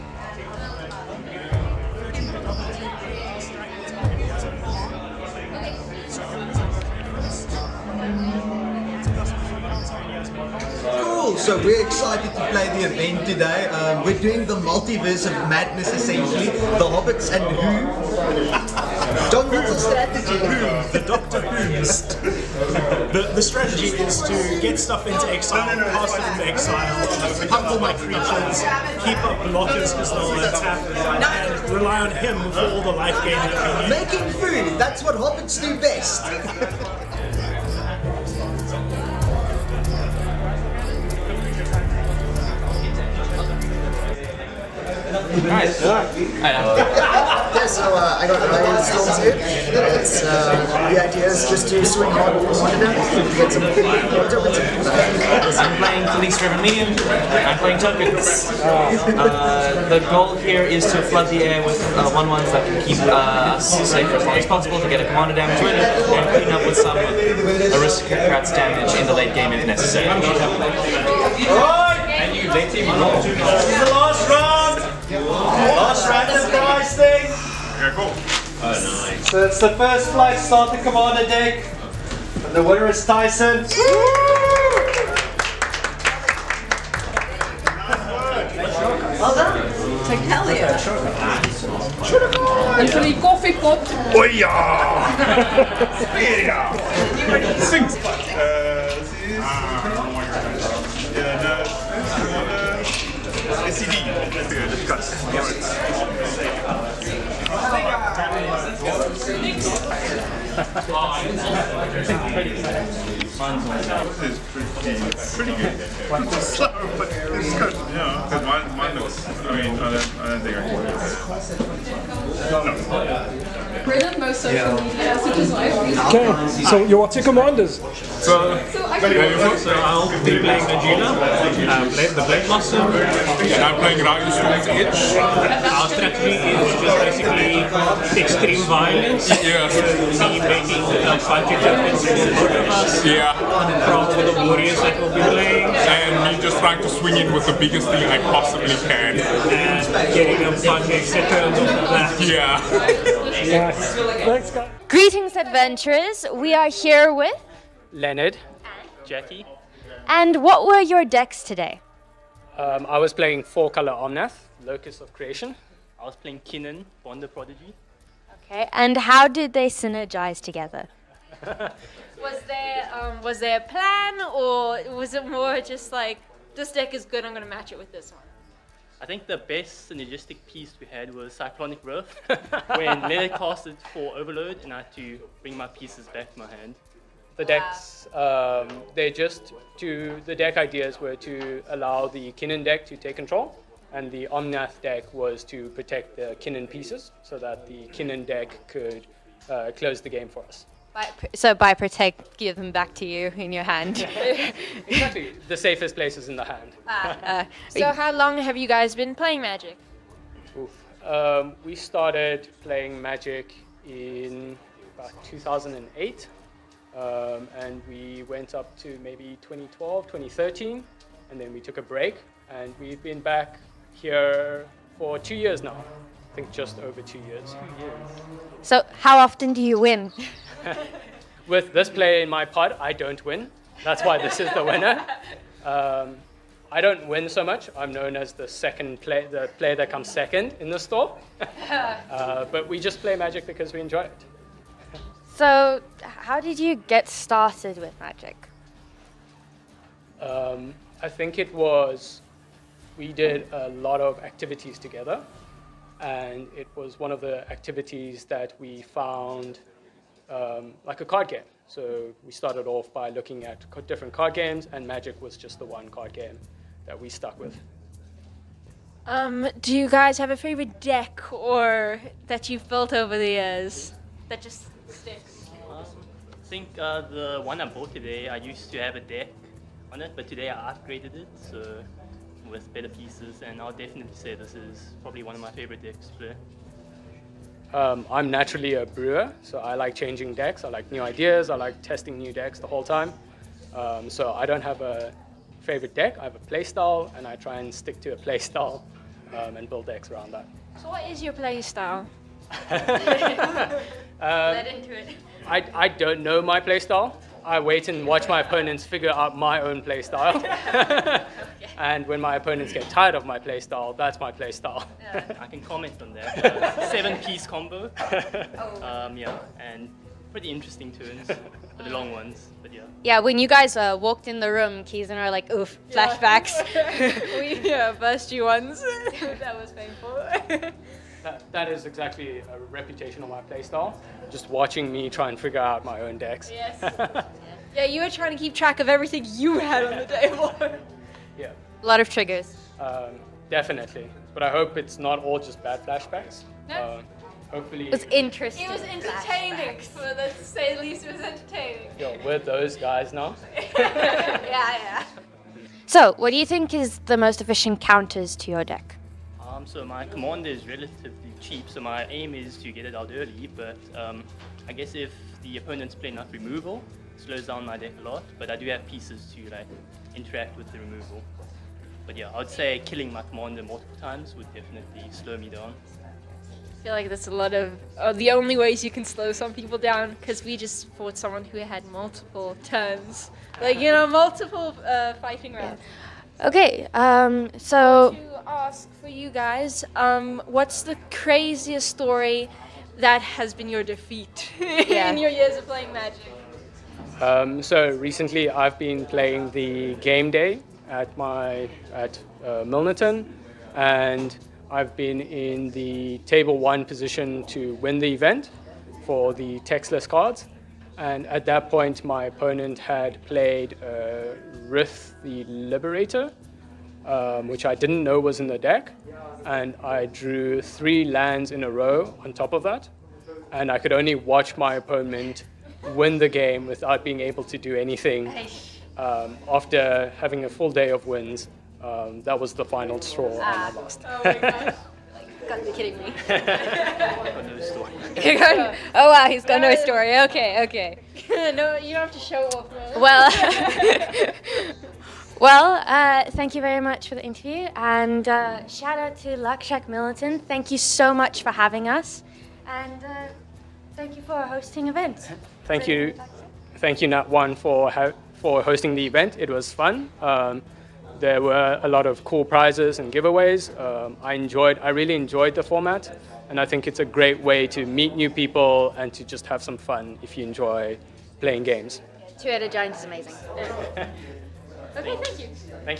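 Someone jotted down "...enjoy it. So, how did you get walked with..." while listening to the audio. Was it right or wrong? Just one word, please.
wrong.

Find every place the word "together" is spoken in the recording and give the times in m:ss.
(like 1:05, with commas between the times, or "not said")
2:50, 4:14.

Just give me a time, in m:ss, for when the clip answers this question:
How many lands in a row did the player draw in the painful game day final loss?
7:00.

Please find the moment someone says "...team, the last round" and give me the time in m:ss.
1:12.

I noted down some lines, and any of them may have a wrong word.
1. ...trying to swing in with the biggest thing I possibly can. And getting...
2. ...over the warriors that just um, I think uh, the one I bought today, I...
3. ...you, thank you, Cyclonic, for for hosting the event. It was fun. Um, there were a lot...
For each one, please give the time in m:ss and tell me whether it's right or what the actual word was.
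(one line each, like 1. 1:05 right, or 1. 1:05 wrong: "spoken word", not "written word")
1. 2:26 right
2. 4:32 wrong: "years", not "warriors"
3. 7:35 wrong: "Natone", not "Cyclonic".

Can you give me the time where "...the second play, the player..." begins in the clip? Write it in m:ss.
3:58.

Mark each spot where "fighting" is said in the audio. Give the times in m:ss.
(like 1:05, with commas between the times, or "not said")
2:21, 6:25.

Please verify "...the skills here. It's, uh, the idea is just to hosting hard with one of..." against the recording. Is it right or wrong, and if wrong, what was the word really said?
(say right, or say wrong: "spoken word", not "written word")
wrong: "swing", not "hosting".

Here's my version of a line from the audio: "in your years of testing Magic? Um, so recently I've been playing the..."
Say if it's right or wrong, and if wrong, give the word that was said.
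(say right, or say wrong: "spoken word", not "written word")
wrong: "playing", not "testing".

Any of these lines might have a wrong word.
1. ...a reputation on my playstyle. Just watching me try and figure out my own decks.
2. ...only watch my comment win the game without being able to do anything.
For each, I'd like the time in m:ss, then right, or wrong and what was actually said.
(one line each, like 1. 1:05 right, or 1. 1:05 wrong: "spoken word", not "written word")
1. 5:32 right
2. 7:03 wrong: "opponent", not "comment".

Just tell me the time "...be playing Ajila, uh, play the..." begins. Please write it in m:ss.
2:10.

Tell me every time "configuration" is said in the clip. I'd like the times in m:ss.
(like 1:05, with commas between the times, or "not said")
not said.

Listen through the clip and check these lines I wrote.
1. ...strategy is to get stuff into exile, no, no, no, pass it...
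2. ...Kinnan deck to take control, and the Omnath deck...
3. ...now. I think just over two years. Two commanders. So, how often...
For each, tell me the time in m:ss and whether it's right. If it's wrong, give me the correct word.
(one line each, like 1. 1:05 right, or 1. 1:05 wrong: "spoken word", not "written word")
1. 0:23 right
2. 3:12 right
3. 3:45 wrong: "years", not "commanders".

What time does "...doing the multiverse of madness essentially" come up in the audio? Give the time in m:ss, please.
0:14.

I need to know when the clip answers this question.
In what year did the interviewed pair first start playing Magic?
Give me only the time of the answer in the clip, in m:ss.
3:35.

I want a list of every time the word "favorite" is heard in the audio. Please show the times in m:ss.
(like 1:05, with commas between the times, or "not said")
4:30, 4:45, 4:55.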